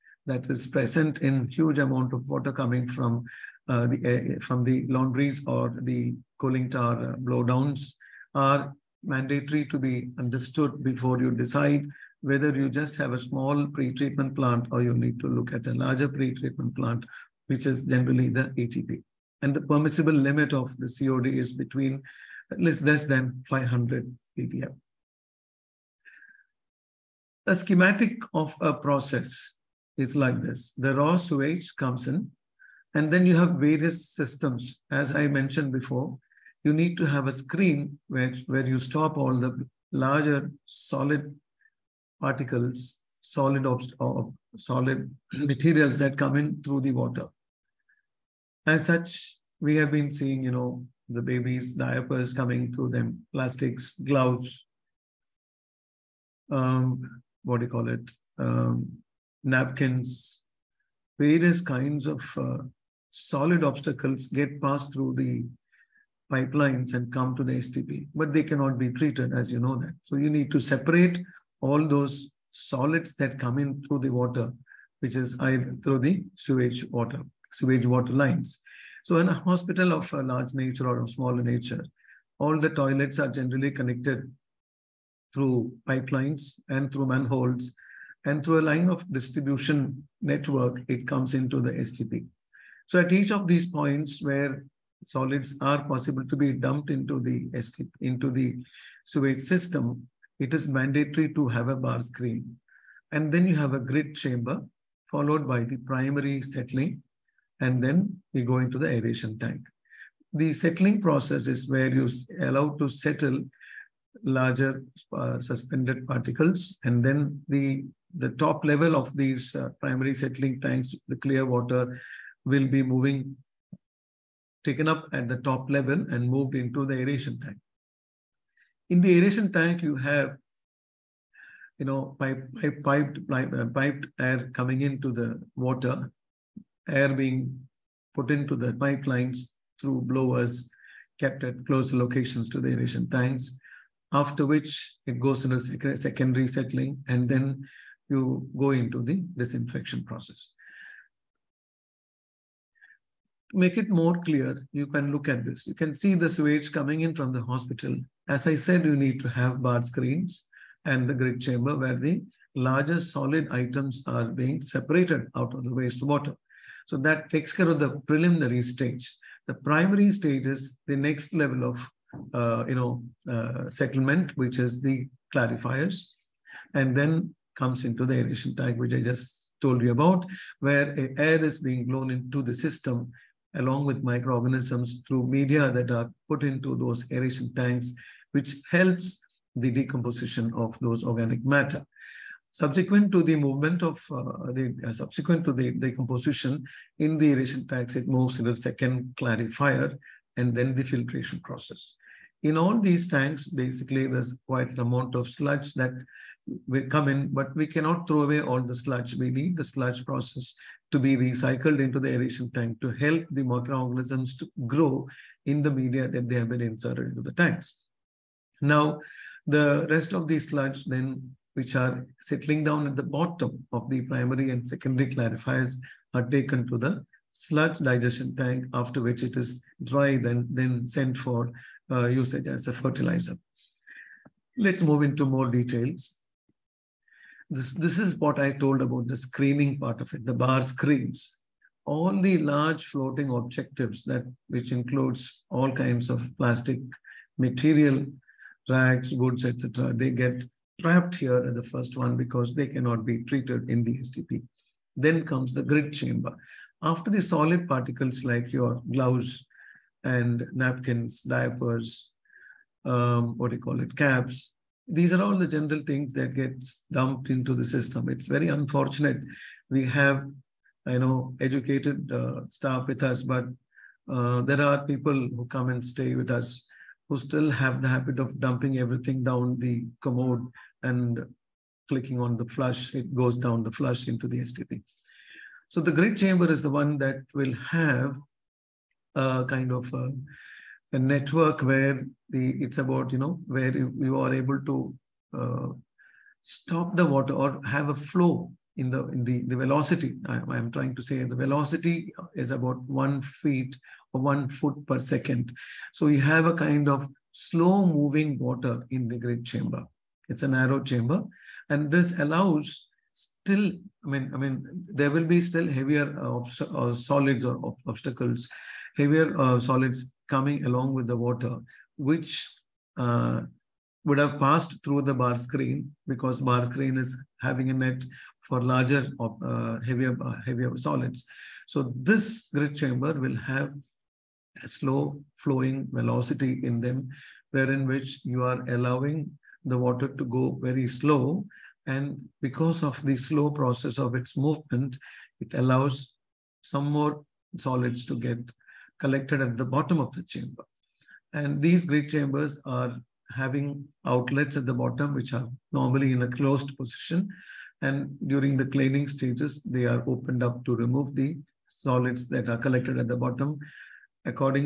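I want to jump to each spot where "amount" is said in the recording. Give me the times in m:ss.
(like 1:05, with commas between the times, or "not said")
0:01, 3:24.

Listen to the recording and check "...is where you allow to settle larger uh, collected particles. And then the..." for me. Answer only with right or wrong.
wrong.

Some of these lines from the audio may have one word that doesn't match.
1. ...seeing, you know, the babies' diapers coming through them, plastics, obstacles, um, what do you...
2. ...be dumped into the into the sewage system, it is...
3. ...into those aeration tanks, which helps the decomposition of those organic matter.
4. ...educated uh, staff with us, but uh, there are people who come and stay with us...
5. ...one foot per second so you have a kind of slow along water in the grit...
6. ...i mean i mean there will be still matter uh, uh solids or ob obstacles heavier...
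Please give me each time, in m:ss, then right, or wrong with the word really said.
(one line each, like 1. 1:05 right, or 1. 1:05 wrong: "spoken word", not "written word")
1. 0:50 wrong: "gloves", not "obstacles"
2. 1:36 right
3. 3:06 right
4. 4:31 right
5. 5:04 wrong: "moving", not "along"
6. 5:14 wrong: "heavier", not "matter".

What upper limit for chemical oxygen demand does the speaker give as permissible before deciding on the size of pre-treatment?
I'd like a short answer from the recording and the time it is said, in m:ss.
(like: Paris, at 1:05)
500 ppm, at 0:23.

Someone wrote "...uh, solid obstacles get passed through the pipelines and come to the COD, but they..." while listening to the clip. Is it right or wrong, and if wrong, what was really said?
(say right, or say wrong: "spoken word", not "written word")
wrong: "STP", not "COD".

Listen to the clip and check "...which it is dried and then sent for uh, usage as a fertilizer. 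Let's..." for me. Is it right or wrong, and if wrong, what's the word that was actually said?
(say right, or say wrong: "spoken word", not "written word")
right.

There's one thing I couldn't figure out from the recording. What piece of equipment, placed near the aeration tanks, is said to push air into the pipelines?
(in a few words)
blowers.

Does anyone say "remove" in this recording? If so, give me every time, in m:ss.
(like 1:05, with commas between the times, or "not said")
6:00.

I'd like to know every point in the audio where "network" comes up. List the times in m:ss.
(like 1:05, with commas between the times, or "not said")
1:30, 4:50.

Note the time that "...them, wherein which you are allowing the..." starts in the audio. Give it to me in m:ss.
5:36.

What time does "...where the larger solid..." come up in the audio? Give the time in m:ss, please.
2:41.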